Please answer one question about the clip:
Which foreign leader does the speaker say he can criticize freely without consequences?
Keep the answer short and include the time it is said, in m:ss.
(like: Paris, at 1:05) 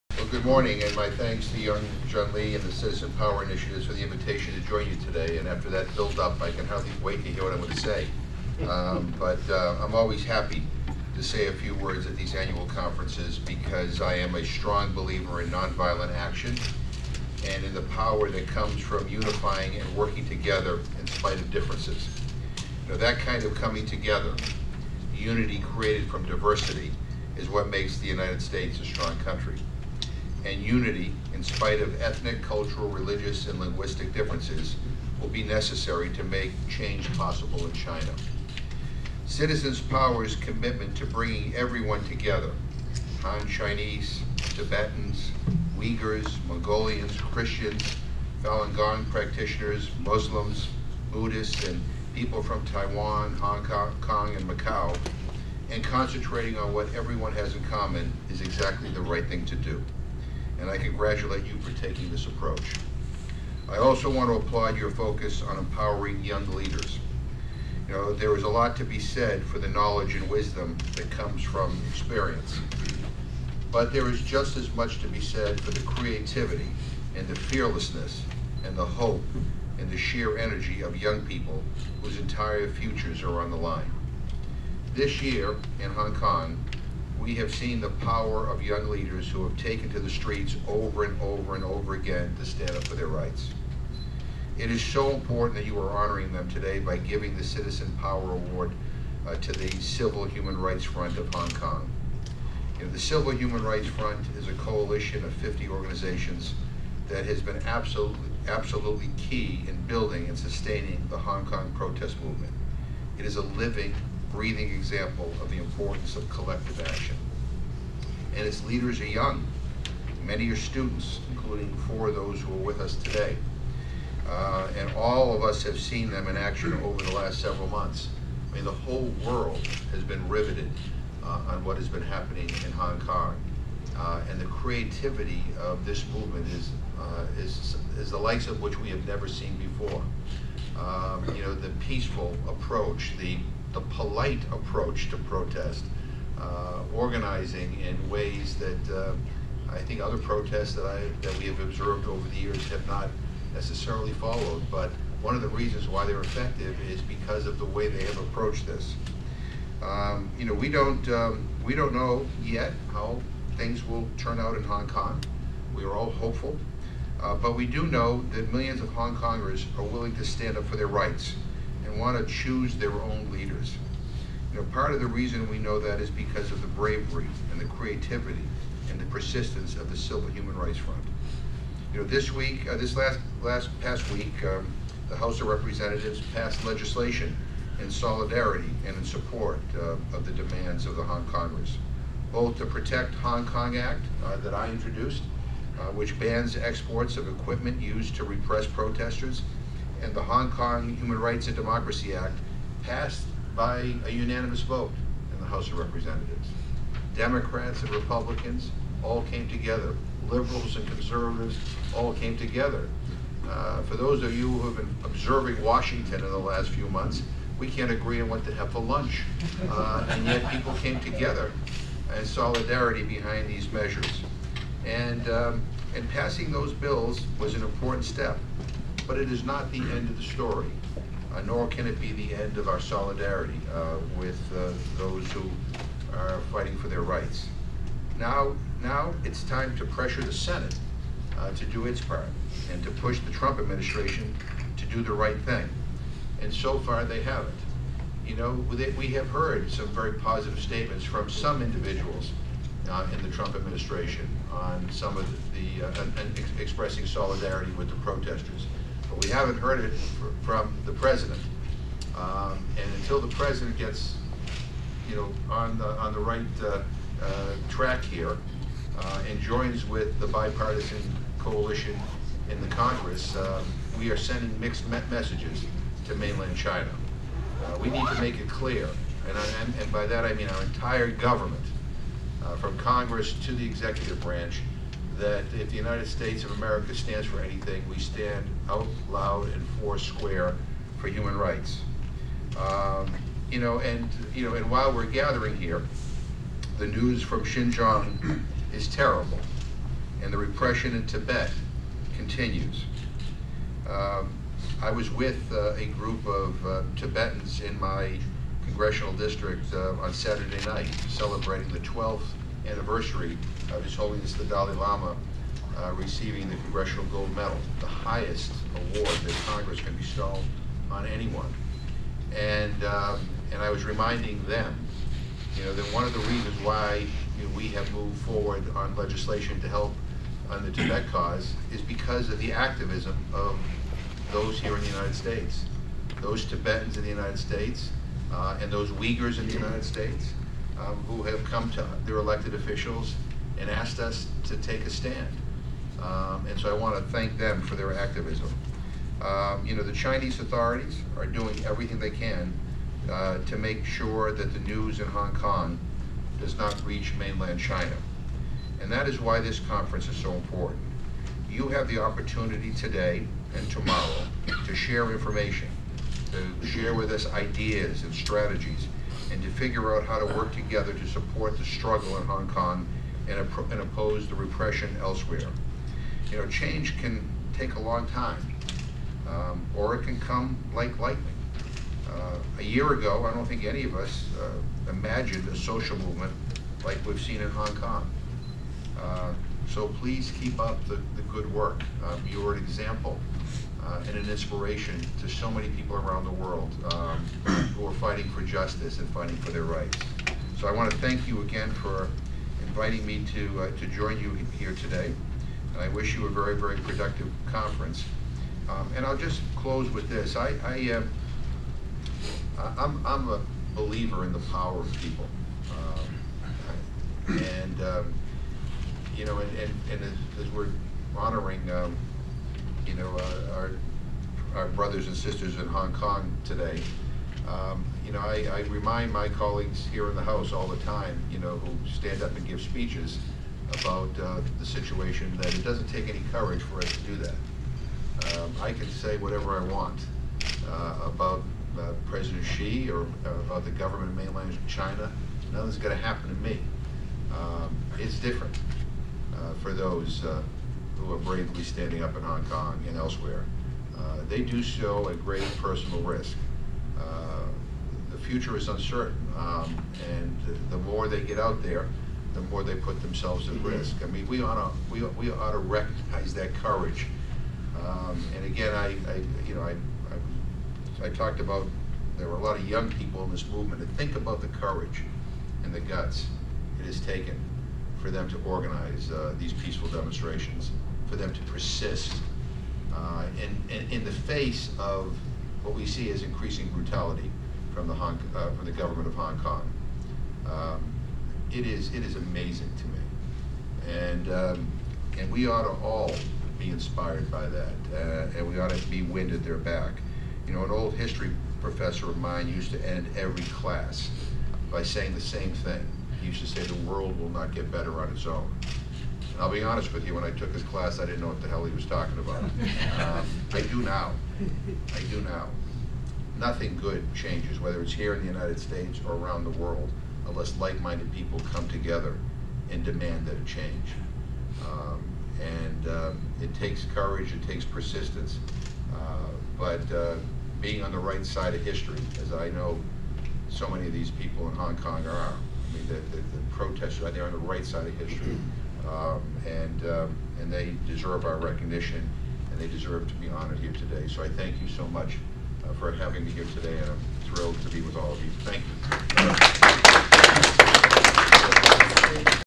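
President Xi, at 7:22.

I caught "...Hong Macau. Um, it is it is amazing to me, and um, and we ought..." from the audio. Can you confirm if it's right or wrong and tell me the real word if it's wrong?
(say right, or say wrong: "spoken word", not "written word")
wrong: "Kong", not "Macau".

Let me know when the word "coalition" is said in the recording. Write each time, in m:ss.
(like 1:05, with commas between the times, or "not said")
1:44, 4:31.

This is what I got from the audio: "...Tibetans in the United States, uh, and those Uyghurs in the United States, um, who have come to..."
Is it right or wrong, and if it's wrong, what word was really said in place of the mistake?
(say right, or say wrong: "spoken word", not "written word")
right.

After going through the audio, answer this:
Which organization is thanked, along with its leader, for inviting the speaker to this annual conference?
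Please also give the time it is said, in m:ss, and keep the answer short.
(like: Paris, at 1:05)
Citizen Power Initiatives, at 0:02.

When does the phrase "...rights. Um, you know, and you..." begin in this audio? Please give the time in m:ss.
4:51.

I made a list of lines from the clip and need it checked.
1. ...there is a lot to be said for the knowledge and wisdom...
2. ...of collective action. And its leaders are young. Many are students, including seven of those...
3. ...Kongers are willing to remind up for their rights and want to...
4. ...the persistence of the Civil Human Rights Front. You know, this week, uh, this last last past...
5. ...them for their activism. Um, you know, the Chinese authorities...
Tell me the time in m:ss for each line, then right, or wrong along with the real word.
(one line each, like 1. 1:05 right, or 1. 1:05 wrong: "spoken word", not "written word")
1. 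1:08 right
2. 1:56 wrong: "four", not "seven"
3. 2:49 wrong: "stand", not "remind"
4. 2:58 right
5. 5:47 right.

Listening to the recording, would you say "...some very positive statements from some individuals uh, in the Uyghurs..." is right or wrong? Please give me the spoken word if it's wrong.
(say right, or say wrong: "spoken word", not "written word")
wrong: "Trump", not "Uyghurs".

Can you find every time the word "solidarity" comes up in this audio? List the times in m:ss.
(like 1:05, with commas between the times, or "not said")
3:07, 3:42, 3:52, 4:17.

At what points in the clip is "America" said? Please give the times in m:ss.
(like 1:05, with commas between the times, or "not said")
4:46.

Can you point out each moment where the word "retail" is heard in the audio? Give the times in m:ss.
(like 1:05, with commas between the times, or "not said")
not said.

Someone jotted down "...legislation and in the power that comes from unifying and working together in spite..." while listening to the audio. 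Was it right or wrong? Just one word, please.
wrong.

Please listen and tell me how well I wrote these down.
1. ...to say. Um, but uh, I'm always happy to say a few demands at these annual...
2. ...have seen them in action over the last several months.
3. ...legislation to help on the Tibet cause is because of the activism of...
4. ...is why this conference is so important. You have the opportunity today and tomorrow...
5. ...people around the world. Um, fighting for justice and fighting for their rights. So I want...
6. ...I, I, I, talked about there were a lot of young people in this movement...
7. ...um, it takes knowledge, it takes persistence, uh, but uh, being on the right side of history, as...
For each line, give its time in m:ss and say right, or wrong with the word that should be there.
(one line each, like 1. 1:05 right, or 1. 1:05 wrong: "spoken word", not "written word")
1. 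0:07 wrong: "words", not "demands"
2. 2:05 right
3. 5:28 right
4. 5:59 right
5. 6:35 right
6. 7:49 right
7. 8:45 wrong: "courage", not "knowledge".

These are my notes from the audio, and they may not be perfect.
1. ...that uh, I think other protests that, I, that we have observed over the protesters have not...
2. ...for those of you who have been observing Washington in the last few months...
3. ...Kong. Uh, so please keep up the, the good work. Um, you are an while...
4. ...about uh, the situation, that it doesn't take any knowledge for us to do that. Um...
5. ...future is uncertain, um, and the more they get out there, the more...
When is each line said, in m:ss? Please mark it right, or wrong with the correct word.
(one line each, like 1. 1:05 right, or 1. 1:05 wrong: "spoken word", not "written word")
1. 2:28 wrong: "years", not "protesters"
2. 3:33 right
3. 6:27 wrong: "example", not "while"
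4. 7:13 wrong: "courage", not "knowledge"
5. 7:38 right.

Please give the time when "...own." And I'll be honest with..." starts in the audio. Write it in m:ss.
8:28.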